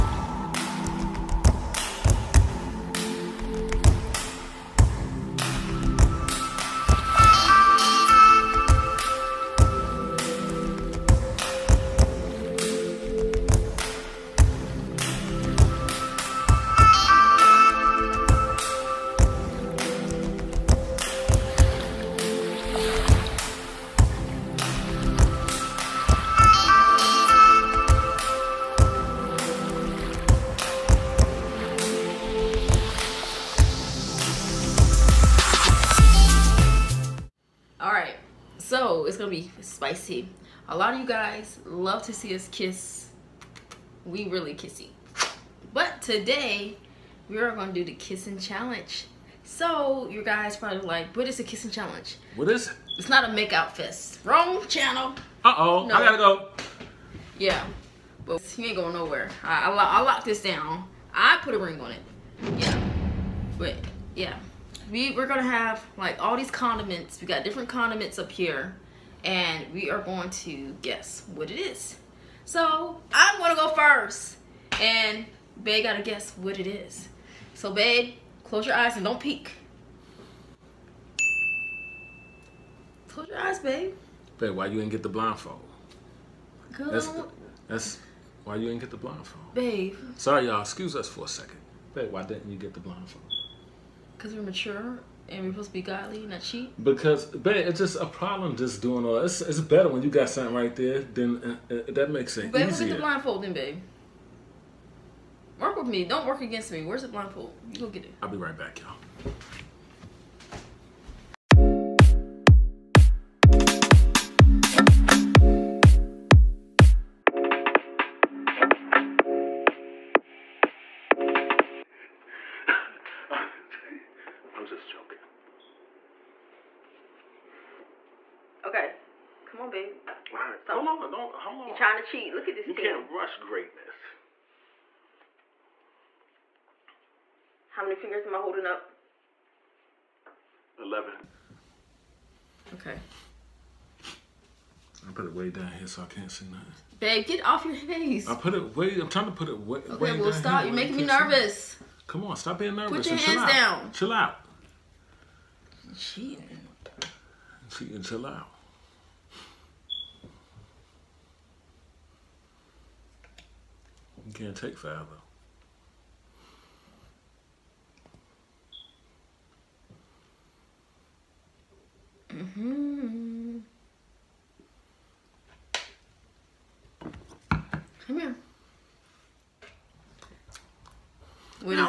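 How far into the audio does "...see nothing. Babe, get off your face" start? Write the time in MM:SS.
02:26.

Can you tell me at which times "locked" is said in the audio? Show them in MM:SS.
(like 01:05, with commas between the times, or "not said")
01:00.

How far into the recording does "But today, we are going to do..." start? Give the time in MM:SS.
00:45.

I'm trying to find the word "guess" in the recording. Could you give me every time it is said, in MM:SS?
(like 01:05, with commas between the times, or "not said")
01:10, 01:16.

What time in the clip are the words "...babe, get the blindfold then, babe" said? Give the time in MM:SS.
01:42.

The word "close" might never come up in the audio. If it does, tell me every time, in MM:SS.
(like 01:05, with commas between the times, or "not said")
01:18, 01:23.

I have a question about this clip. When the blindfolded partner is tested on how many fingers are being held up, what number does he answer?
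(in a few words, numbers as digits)
11.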